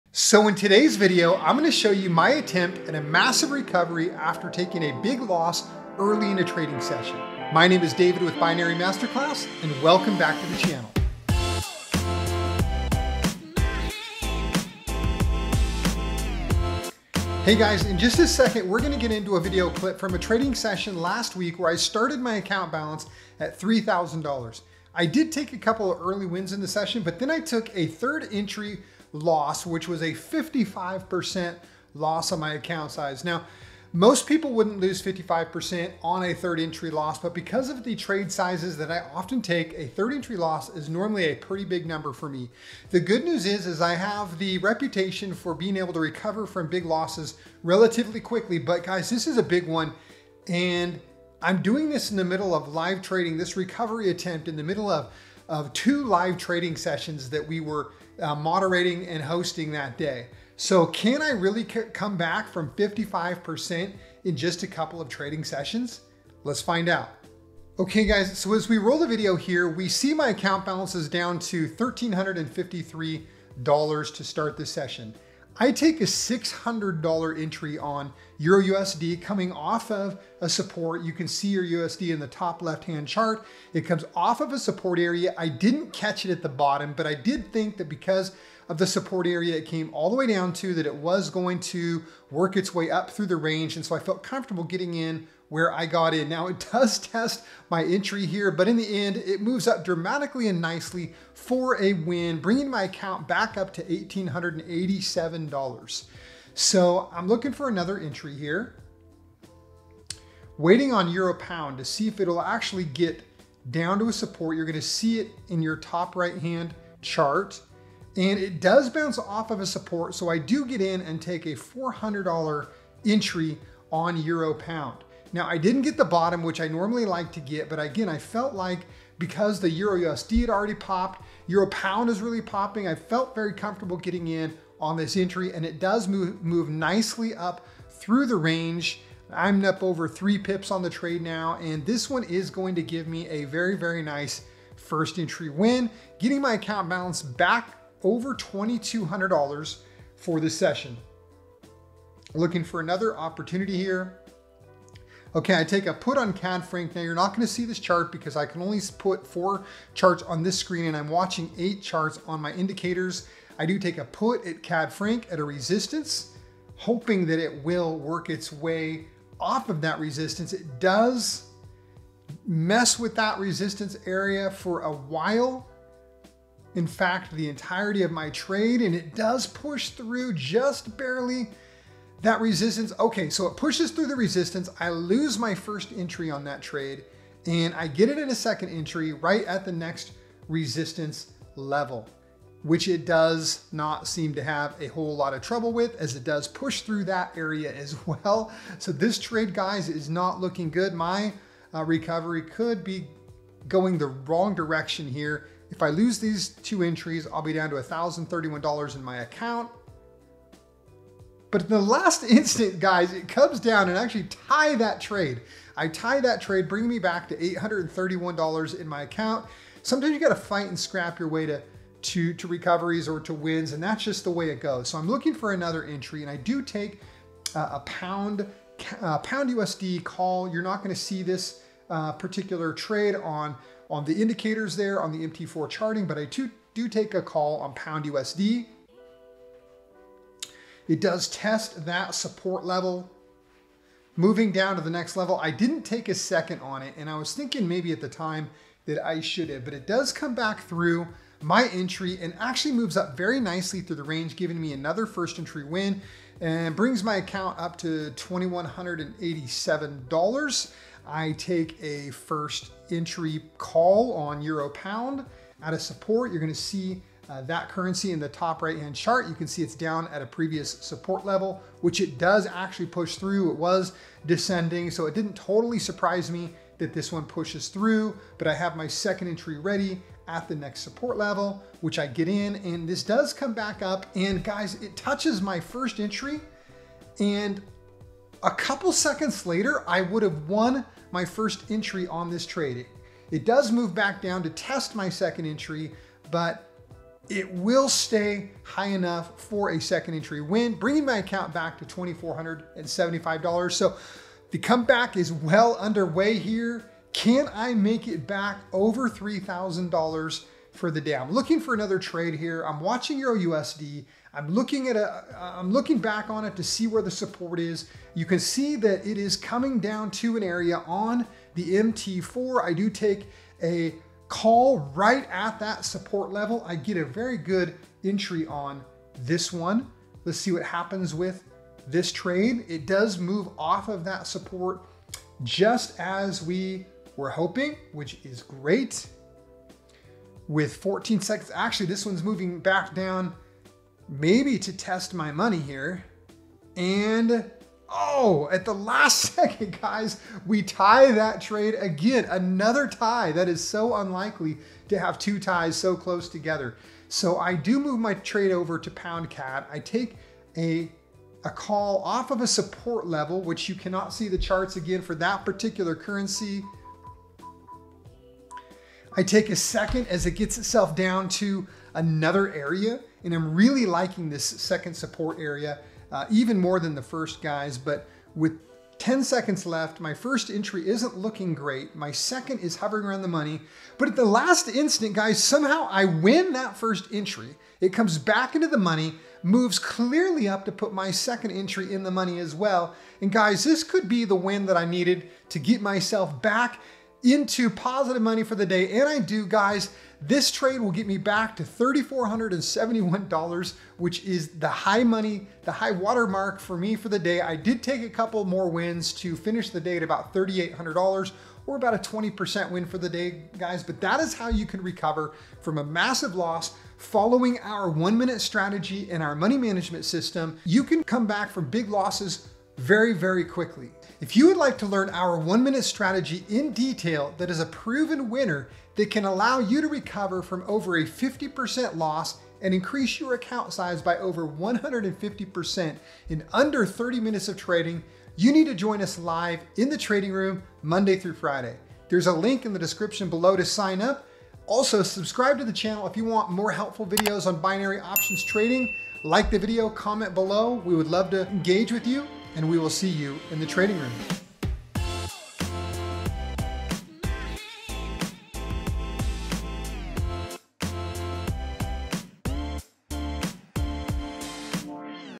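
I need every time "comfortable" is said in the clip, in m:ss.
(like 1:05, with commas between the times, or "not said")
1:34, 2:13.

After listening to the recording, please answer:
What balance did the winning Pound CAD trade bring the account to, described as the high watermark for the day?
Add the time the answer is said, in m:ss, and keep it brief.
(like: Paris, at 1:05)
$3,471, at 6:41.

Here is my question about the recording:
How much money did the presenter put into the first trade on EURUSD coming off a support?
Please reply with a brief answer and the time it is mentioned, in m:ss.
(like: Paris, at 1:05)
$600, at 1:16.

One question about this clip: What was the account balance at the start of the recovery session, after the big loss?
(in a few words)
$1,353.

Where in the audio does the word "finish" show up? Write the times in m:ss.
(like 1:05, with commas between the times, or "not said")
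6:49.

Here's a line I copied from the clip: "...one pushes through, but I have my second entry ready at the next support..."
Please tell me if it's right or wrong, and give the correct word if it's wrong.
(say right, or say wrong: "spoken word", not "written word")
right.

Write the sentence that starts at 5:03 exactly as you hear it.
So the comeback is well underway here.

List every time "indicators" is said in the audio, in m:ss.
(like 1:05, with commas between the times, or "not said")
2:42, 3:54.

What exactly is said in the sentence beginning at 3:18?
So this trade, guys, is not looking good.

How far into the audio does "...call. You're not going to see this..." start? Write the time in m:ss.
3:50.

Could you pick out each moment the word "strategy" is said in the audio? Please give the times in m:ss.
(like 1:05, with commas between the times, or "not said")
6:58, 7:05.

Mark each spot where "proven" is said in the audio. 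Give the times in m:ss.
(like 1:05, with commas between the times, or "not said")
7:07.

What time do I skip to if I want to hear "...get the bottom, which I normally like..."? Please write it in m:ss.
2:05.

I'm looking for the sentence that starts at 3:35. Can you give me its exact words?
I tie that trade, bring me back to $831 in my account.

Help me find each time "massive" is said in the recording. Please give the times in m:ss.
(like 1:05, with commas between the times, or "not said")
0:03, 6:55.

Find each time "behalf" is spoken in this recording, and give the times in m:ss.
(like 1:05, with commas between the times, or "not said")
not said.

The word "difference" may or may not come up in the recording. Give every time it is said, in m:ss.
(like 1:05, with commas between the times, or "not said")
not said.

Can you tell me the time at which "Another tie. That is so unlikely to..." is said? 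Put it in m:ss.
5:52.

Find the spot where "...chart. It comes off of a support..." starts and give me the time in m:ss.
1:23.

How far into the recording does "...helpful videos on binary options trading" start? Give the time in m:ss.
7:26.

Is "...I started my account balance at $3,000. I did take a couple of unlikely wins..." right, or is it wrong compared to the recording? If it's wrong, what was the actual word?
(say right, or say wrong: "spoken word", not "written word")
wrong: "early", not "unlikely".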